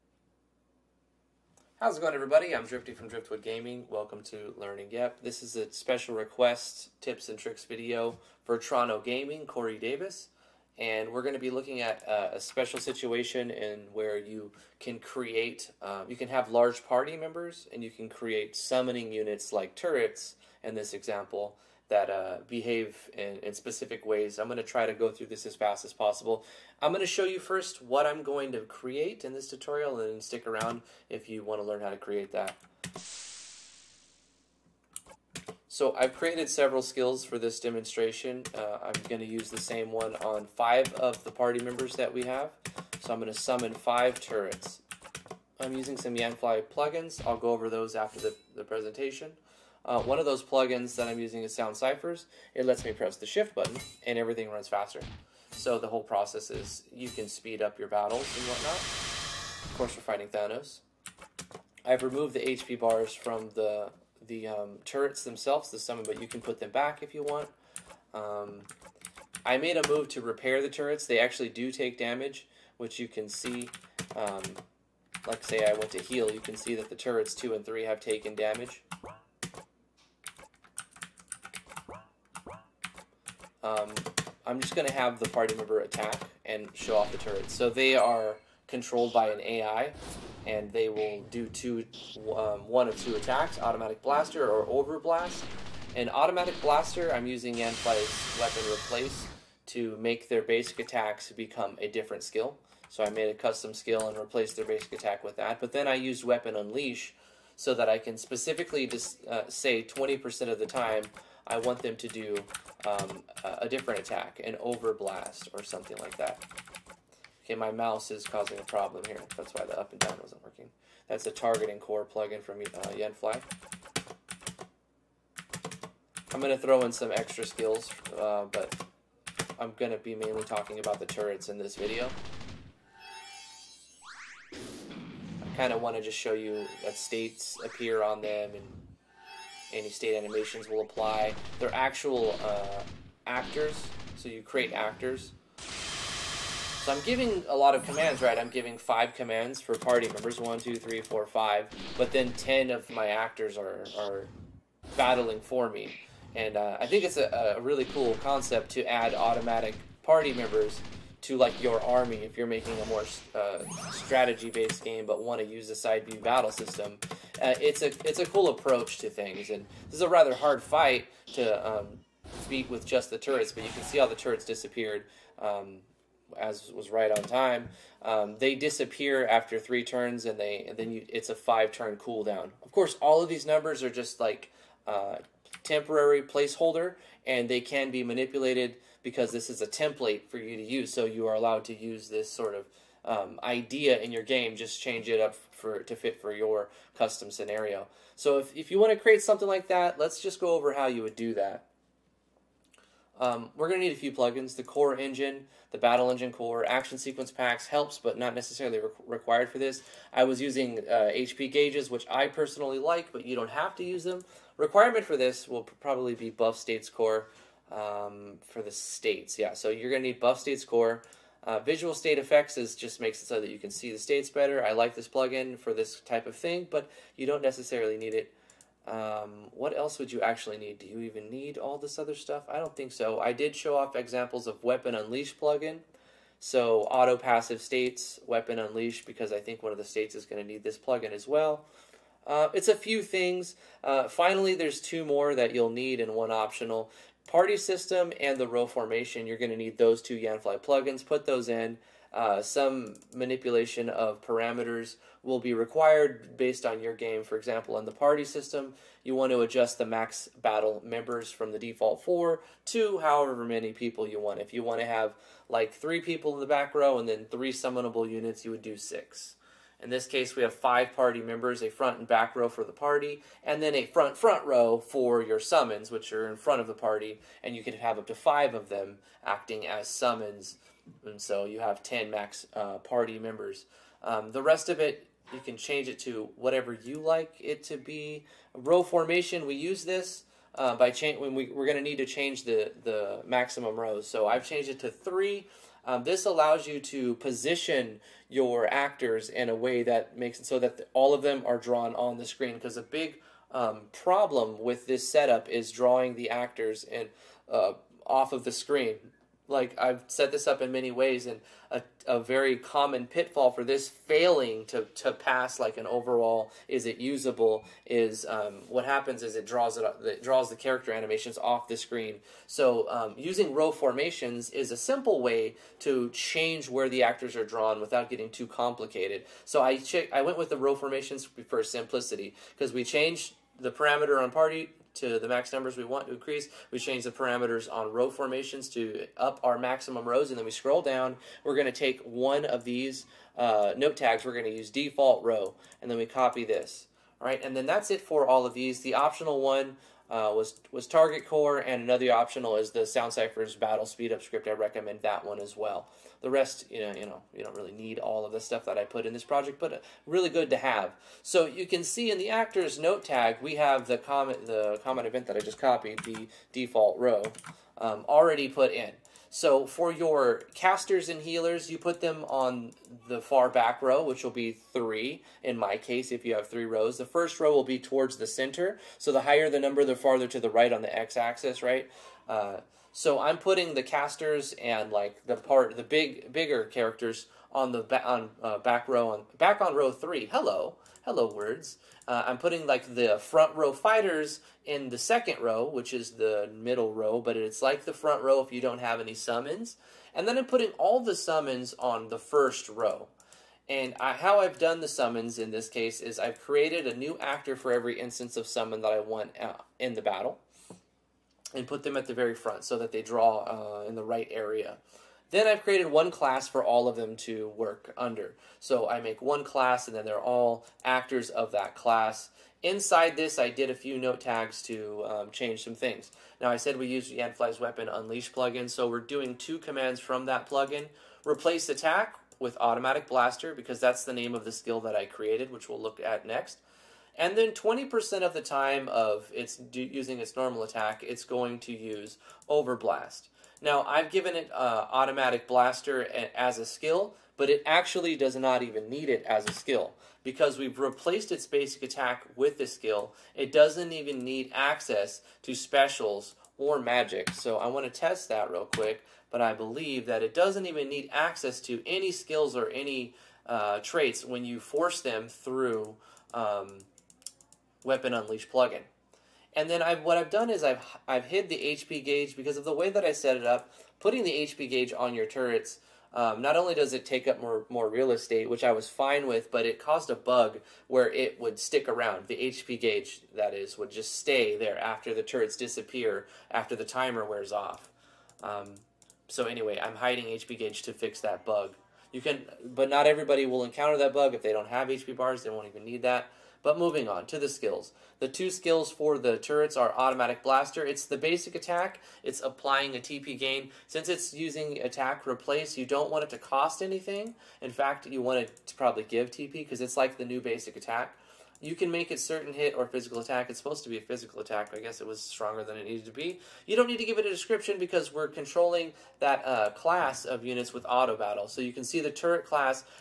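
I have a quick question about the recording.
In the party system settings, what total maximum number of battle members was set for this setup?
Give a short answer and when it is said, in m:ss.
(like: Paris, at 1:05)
10, at 4:41.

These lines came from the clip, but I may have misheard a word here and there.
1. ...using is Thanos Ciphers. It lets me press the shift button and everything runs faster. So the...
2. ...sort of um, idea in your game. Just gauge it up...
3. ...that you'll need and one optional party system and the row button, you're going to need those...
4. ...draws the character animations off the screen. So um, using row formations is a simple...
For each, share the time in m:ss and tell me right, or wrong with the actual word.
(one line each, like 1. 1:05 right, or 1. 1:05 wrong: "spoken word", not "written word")
1. 0:51 wrong: "Sound", not "Thanos"
2. 3:12 wrong: "change", not "gauge"
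3. 4:05 wrong: "formation", not "button"
4. 5:20 right.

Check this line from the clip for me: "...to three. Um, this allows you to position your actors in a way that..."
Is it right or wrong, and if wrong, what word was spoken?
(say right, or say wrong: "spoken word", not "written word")
right.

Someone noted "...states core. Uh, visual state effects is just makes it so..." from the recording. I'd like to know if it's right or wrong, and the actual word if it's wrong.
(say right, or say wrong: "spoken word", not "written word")
right.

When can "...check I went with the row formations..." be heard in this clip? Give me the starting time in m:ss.
5:29.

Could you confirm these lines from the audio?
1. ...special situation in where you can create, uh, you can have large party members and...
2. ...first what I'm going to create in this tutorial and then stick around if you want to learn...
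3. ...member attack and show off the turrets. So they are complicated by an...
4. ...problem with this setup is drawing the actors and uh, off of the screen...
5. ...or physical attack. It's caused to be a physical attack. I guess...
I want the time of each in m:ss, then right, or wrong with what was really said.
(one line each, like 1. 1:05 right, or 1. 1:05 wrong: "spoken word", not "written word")
1. 0:12 right
2. 0:27 right
3. 1:25 wrong: "controlled", not "complicated"
4. 5:03 right
5. 8:32 wrong: "supposed", not "caused".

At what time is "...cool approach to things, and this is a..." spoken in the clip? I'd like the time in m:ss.
2:48.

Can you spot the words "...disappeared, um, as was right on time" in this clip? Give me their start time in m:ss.
2:54.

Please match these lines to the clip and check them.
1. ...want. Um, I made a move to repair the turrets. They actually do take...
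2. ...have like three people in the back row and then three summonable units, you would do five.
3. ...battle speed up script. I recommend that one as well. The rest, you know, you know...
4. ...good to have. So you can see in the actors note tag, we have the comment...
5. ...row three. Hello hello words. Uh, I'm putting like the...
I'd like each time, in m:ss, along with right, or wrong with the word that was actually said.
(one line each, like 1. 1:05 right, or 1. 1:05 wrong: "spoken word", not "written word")
1. 1:07 right
2. 4:24 wrong: "six", not "five"
3. 5:53 right
4. 6:00 right
5. 6:29 right.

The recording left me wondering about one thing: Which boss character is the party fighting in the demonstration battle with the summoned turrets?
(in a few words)
Thanos.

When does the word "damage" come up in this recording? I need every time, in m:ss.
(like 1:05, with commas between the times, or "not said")
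1:11, 1:18.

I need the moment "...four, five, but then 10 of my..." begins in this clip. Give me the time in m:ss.
2:31.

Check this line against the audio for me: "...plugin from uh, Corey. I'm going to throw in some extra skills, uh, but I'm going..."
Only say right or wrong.
wrong.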